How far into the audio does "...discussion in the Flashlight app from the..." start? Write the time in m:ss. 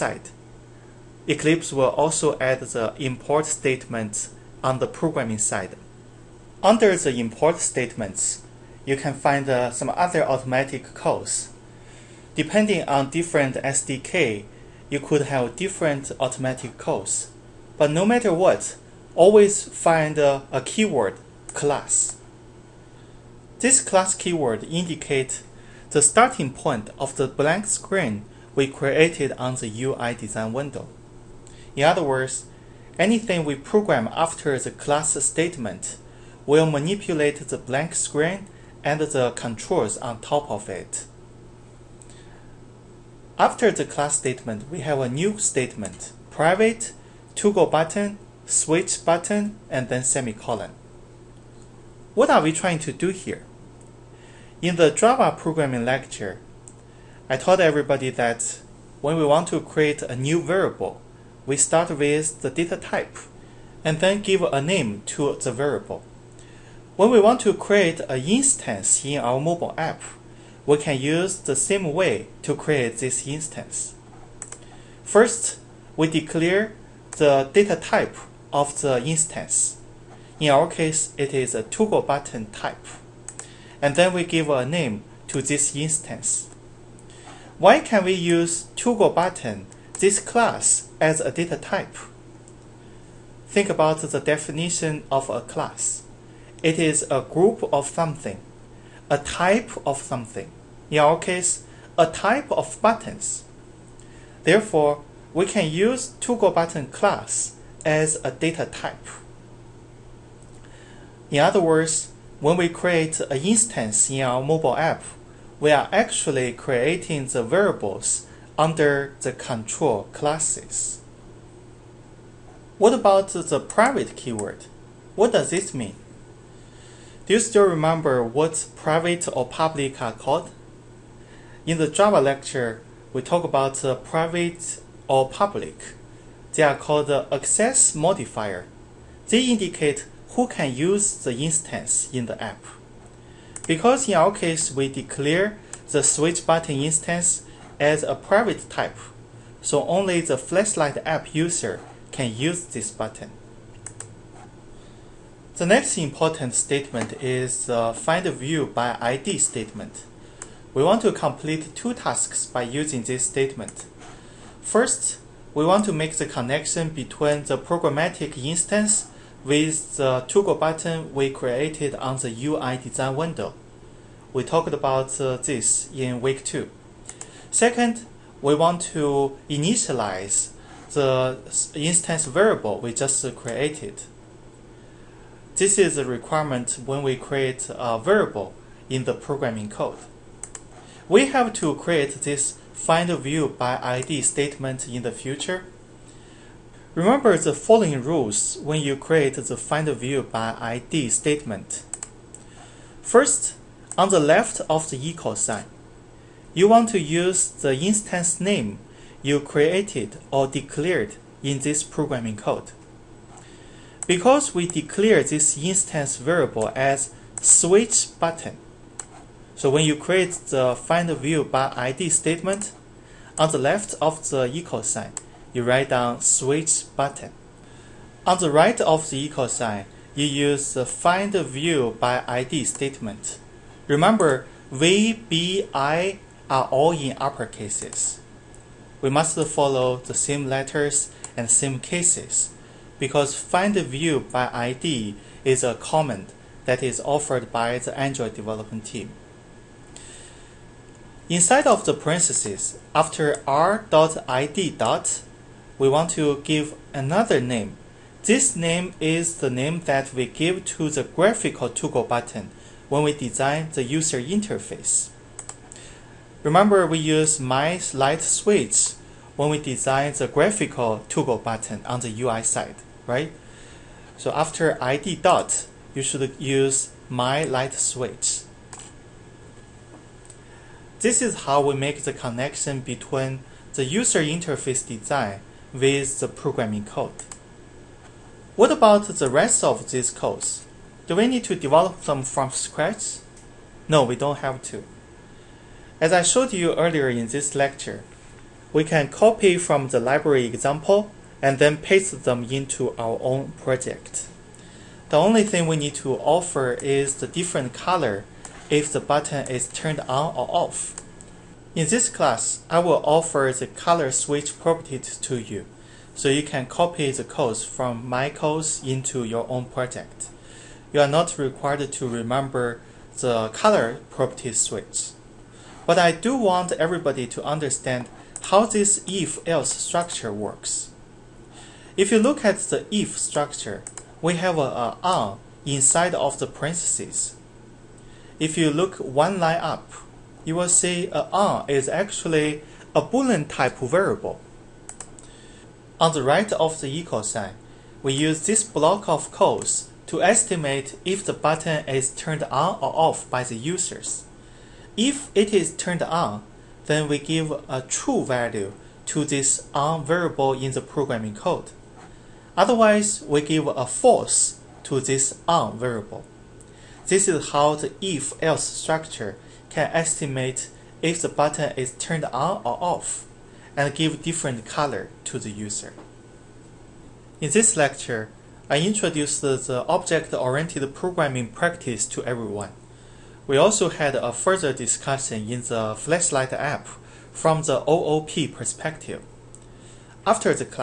6:24.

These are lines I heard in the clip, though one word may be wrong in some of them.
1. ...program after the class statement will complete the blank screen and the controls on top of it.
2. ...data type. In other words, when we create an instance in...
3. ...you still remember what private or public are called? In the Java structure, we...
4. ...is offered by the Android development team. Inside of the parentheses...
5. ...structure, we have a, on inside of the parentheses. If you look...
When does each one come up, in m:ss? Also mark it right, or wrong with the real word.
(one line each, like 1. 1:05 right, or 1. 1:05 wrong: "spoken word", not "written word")
1. 0:33 wrong: "manipulate", not "complete"
2. 1:48 right
3. 2:07 wrong: "lecture", not "structure"
4. 4:06 right
5. 5:33 right.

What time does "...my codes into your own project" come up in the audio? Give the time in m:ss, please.
5:18.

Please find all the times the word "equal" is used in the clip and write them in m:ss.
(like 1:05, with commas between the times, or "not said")
3:25, 3:44, 3:49, 5:46.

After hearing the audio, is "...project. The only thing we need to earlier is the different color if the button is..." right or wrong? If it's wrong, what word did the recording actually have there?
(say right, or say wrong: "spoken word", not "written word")
wrong: "offer", not "earlier".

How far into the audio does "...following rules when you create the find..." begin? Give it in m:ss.
3:17.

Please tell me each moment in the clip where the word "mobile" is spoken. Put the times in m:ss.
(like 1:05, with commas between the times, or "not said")
1:09, 1:54.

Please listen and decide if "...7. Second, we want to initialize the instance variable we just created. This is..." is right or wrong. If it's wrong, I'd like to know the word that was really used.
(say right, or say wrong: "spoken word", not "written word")
wrong: "2", not "7".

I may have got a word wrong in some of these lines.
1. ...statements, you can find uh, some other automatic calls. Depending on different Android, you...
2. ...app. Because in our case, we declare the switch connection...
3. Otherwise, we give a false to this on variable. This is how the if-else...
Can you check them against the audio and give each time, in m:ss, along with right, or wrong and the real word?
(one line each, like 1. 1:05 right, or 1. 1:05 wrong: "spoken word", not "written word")
1. 0:07 wrong: "SDK", not "Android"
2. 2:22 wrong: "button", not "connection"
3. 6:02 right.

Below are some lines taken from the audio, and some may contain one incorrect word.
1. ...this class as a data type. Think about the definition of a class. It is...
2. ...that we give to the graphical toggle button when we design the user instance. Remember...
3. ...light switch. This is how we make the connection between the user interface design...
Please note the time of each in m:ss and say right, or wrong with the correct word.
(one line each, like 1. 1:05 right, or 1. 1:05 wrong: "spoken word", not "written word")
1. 1:29 right
2. 4:19 wrong: "interface", not "instance"
3. 4:37 right.